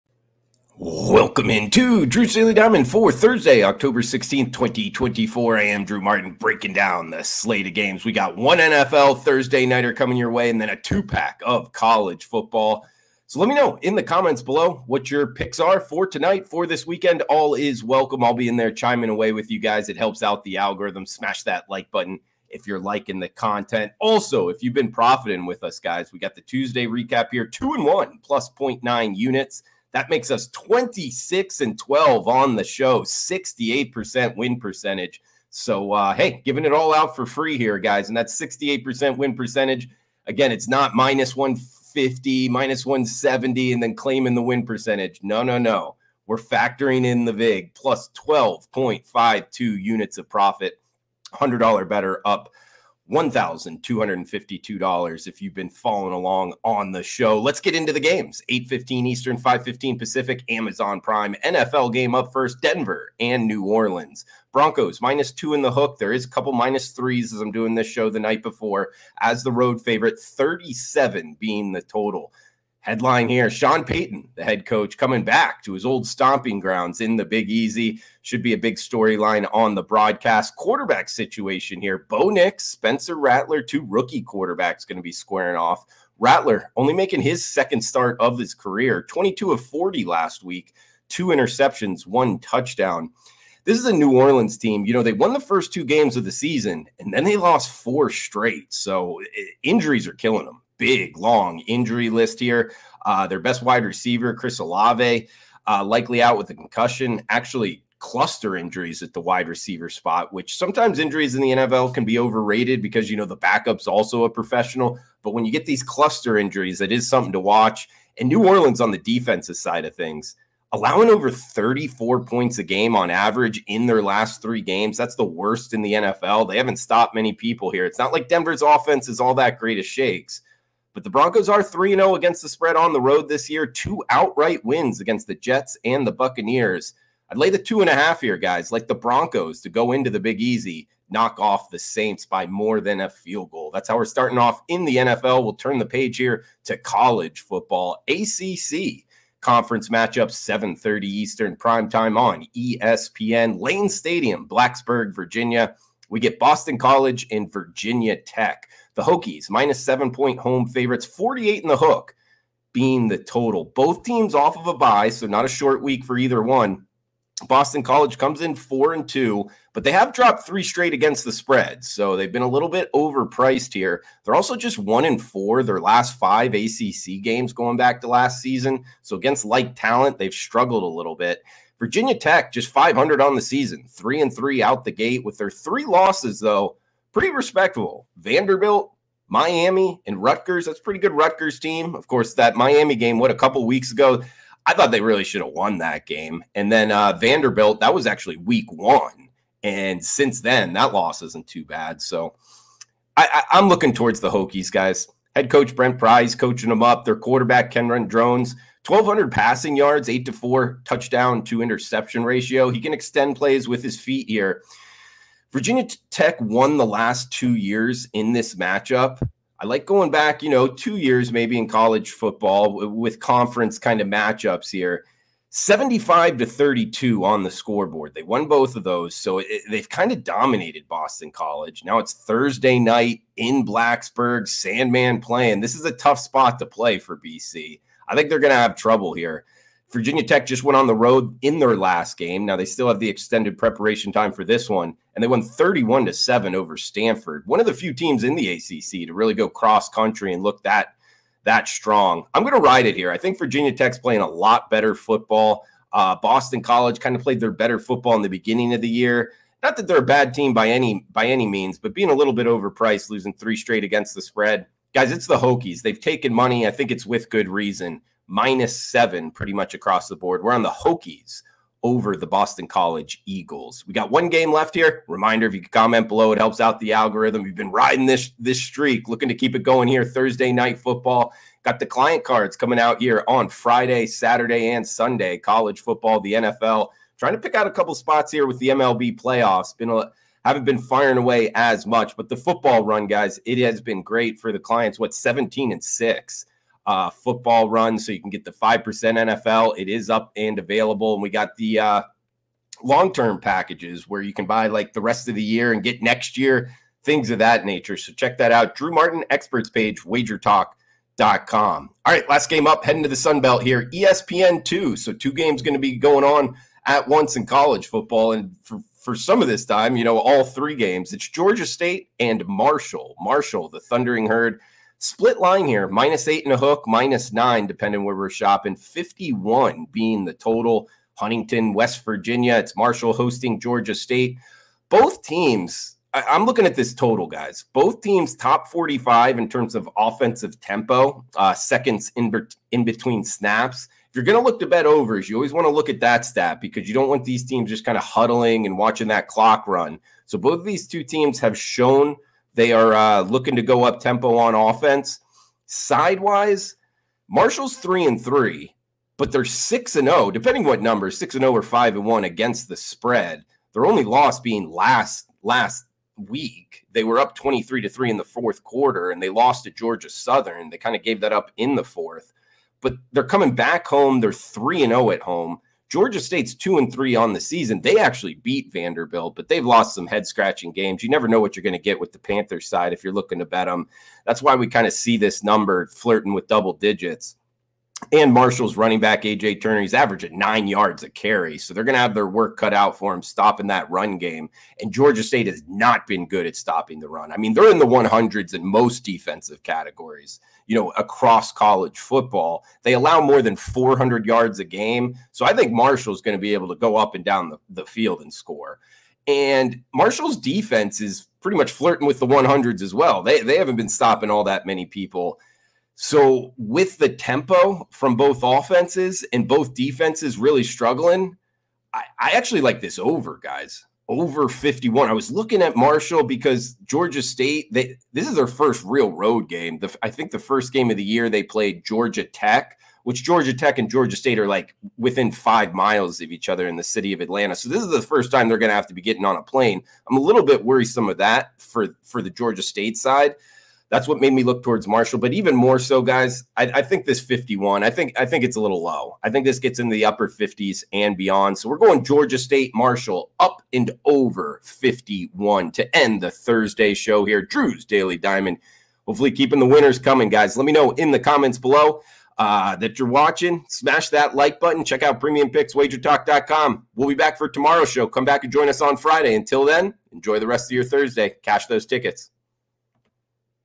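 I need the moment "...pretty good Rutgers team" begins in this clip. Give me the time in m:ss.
3:10.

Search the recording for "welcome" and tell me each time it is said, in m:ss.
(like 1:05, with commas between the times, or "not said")
0:00, 0:17.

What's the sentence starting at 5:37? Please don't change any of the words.
Both teams top 45 in terms of offensive tempo, uh, seconds in, be in between snaps.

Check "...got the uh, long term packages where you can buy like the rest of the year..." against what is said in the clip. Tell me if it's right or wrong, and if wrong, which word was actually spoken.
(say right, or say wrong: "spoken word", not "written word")
right.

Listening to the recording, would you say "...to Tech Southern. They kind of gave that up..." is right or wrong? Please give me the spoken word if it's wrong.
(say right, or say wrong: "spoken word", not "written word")
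wrong: "Georgia", not "Tech".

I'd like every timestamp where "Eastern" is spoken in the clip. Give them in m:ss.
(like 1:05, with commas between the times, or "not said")
0:59, 2:31.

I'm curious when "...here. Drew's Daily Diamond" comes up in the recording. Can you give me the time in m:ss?
7:37.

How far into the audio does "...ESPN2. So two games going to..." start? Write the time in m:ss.
5:13.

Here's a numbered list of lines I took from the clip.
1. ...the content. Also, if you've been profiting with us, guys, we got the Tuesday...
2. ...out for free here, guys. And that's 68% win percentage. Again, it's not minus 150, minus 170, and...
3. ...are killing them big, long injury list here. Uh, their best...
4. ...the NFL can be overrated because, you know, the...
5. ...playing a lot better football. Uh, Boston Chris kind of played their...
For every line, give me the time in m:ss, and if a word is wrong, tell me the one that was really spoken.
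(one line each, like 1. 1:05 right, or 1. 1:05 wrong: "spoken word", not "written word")
1. 0:23 right
2. 0:36 right
3. 1:40 right
4. 1:51 right
5. 4:13 wrong: "College", not "Chris".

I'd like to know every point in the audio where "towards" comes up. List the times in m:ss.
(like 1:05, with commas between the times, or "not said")
3:23, 7:24.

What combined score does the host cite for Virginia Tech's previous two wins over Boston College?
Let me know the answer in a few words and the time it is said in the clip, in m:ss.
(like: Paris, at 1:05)
75 to 32, at 3:45.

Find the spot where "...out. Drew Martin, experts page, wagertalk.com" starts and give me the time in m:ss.
5:08.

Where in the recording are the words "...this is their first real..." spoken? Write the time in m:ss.
7:08.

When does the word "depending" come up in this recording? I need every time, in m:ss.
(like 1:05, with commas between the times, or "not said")
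5:27, 6:00.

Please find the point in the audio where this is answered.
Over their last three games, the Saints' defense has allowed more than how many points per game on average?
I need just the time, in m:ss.
2:01.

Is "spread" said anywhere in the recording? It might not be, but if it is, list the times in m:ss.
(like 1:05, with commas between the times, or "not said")
2:12, 2:51, 4:24, 6:02.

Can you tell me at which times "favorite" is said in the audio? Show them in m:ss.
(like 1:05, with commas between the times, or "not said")
1:09, 2:40.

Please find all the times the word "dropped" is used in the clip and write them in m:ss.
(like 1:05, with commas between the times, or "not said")
2:50.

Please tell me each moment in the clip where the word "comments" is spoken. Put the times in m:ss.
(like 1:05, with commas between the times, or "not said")
0:14, 4:35, 7:41.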